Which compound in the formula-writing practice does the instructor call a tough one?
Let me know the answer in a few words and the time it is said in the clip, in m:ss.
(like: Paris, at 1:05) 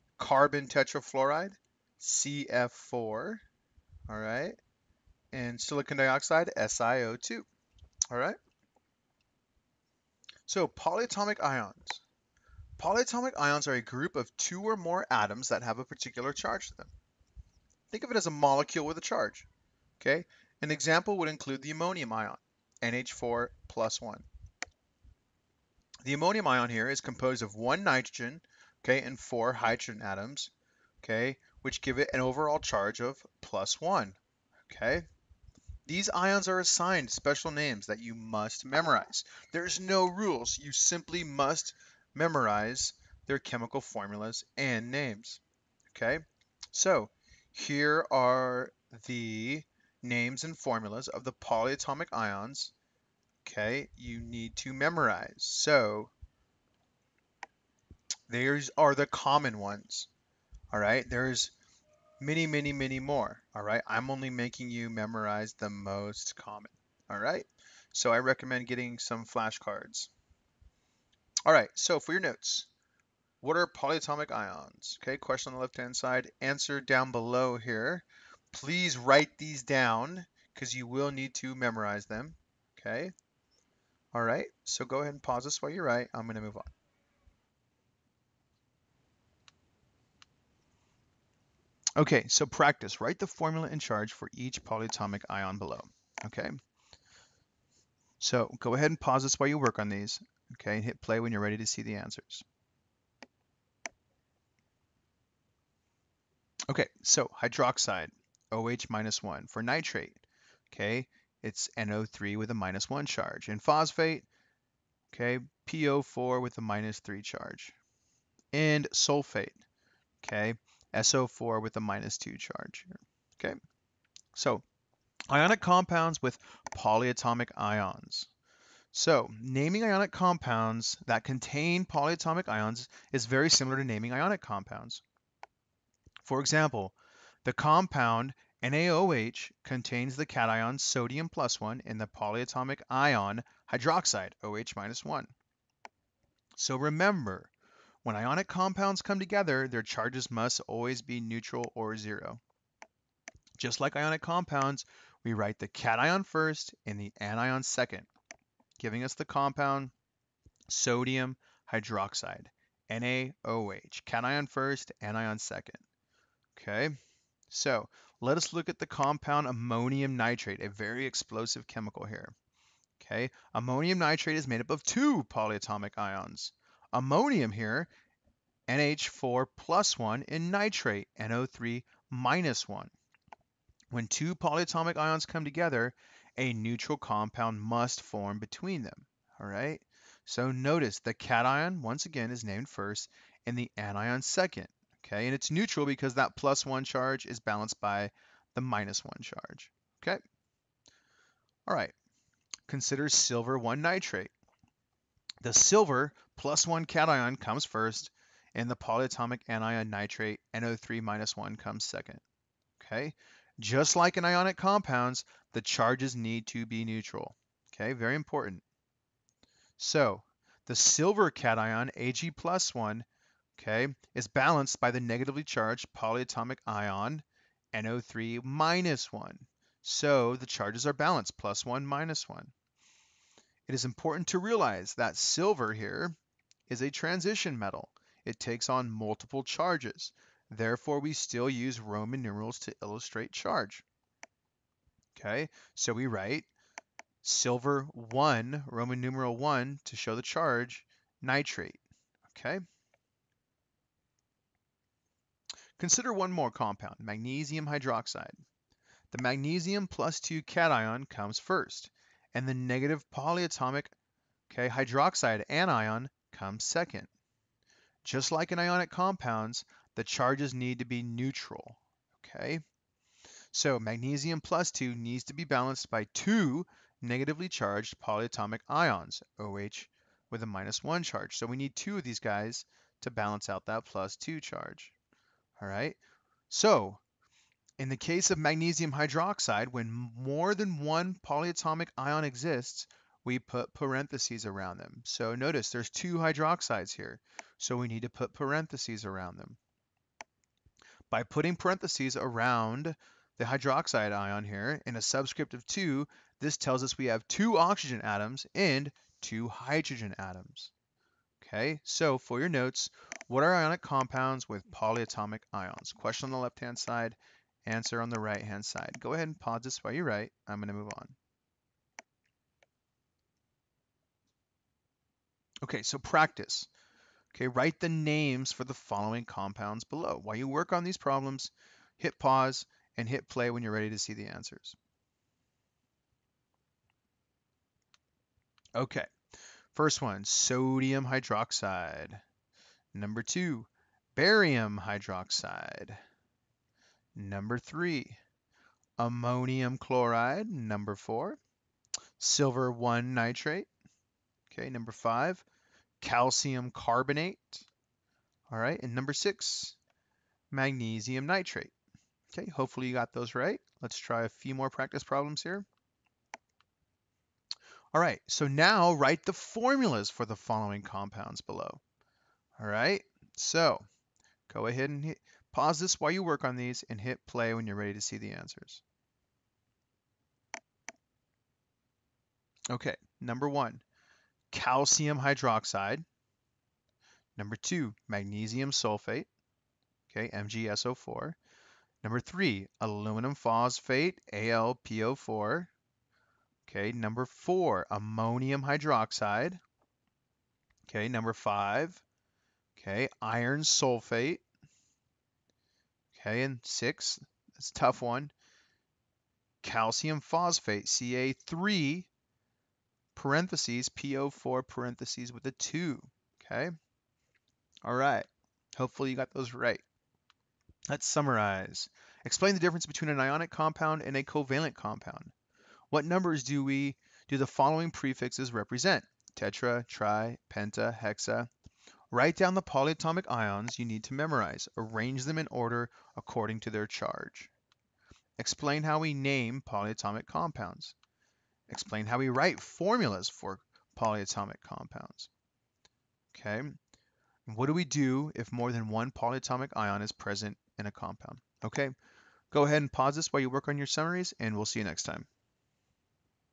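calcium phosphate, at 6:49.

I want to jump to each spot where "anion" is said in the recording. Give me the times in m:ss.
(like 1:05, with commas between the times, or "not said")
2:37, 2:45, 3:13, 3:29, 4:25.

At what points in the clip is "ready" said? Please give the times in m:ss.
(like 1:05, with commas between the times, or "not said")
1:41, 5:33, 6:17.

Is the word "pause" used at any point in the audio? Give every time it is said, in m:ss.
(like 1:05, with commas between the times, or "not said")
1:25, 1:39, 5:19, 5:32, 6:15, 7:32.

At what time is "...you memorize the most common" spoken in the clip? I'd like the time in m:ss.
1:04.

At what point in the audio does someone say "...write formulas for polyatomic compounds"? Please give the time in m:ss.
7:22.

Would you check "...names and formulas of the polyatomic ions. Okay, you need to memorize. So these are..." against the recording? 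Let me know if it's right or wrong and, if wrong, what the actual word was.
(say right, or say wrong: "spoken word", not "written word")
right.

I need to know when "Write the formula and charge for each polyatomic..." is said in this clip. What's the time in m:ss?
1:33.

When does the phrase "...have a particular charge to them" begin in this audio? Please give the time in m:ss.
0:15.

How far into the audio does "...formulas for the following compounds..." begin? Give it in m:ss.
6:09.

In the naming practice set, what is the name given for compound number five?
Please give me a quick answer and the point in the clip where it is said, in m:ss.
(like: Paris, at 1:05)
calcium carbonate, at 5:56.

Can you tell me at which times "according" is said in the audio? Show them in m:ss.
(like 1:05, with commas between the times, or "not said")
7:16.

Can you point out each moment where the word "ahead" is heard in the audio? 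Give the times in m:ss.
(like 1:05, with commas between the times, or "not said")
1:24, 1:38, 5:19, 6:14, 7:32.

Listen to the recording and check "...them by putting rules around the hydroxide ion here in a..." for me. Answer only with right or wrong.
wrong.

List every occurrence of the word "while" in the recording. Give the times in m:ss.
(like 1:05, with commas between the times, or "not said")
1:25, 1:39, 5:19, 5:30, 6:15, 7:33.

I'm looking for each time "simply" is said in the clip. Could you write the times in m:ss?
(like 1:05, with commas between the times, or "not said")
0:40.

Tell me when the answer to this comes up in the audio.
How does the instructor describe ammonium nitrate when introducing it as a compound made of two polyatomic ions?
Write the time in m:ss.
2:50.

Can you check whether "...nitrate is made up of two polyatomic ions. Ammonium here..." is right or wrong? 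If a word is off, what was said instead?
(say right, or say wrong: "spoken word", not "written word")
right.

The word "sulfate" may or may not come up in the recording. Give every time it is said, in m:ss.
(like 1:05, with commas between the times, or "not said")
1:58, 6:28, 6:43.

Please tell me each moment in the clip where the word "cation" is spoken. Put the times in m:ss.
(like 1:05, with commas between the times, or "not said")
2:20, 2:35, 2:44, 3:11, 3:26, 3:41, 4:20.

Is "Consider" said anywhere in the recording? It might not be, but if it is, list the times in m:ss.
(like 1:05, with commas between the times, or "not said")
3:22, 4:15.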